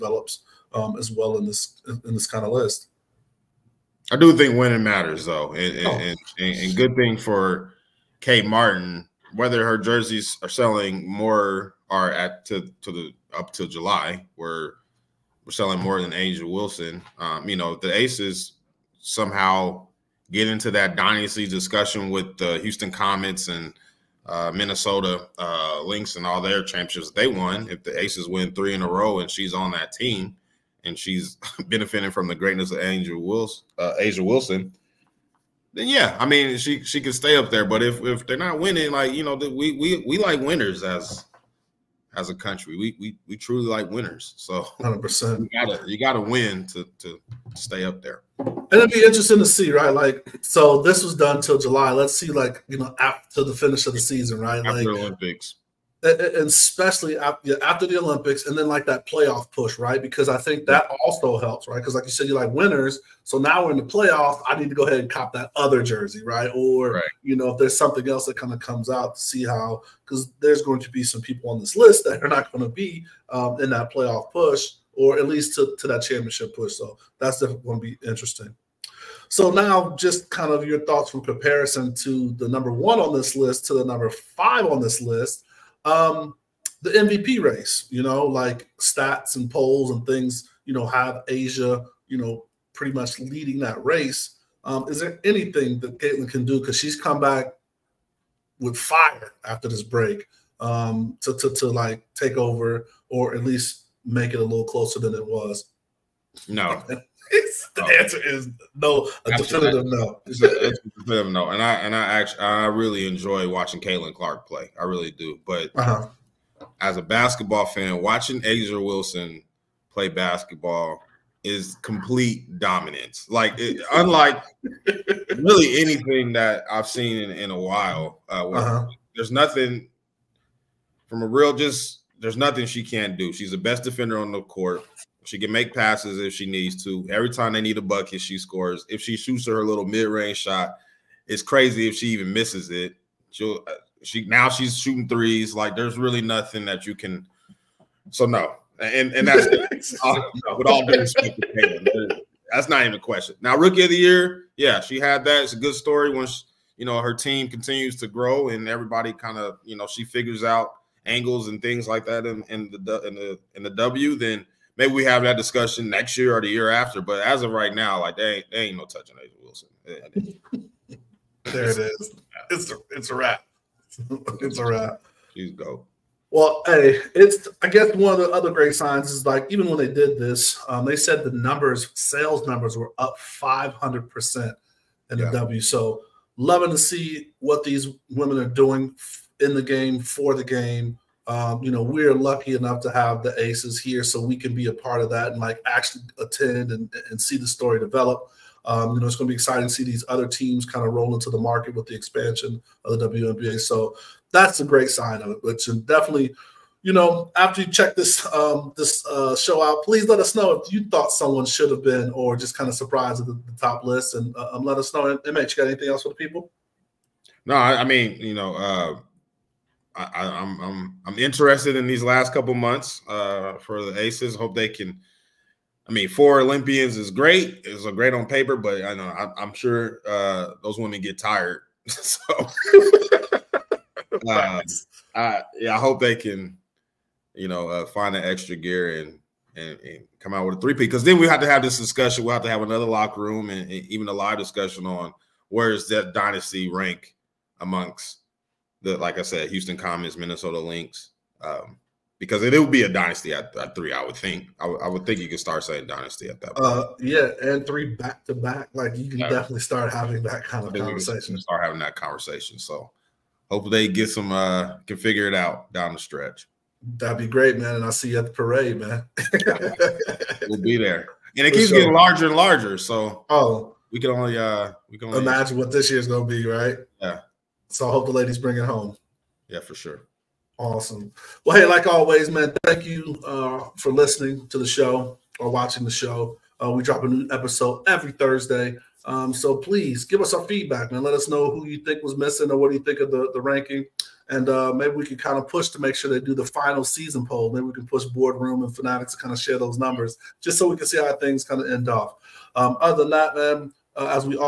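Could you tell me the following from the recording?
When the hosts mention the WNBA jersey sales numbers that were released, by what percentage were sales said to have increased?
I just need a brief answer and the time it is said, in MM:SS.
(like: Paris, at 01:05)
500%, at 03:03.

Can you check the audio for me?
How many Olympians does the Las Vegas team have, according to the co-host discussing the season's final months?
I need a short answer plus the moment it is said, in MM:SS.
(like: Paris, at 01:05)
4, at 03:46.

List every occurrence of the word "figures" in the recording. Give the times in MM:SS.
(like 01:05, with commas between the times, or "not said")
02:40, 04:24.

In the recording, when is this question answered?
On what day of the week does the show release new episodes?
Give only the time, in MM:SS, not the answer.
04:48.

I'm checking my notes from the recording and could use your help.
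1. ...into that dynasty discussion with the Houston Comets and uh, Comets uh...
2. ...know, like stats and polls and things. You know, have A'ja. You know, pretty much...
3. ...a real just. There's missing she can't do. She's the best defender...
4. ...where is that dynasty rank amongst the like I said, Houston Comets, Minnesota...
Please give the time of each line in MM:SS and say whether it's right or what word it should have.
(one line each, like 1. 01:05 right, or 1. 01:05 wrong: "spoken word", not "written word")
1. 00:20 wrong: "Minnesota", not "Comets"
2. 01:28 right
3. 02:11 wrong: "nothing", not "missing"
4. 04:05 right.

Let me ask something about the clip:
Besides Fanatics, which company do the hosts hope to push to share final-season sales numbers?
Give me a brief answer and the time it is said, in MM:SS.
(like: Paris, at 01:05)
Boardroom, at 04:58.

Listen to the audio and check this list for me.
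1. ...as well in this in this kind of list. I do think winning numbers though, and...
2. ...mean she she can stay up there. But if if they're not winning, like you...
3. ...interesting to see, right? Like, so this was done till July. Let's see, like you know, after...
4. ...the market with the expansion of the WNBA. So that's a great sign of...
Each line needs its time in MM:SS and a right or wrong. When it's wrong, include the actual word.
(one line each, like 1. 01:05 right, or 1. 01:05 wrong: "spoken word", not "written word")
1. 00:00 wrong: "matters", not "numbers"
2. 00:36 right
3. 00:49 right
4. 03:21 right.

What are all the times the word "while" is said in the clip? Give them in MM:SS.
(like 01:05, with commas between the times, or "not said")
02:07.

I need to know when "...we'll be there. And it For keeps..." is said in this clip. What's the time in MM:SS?
04:30.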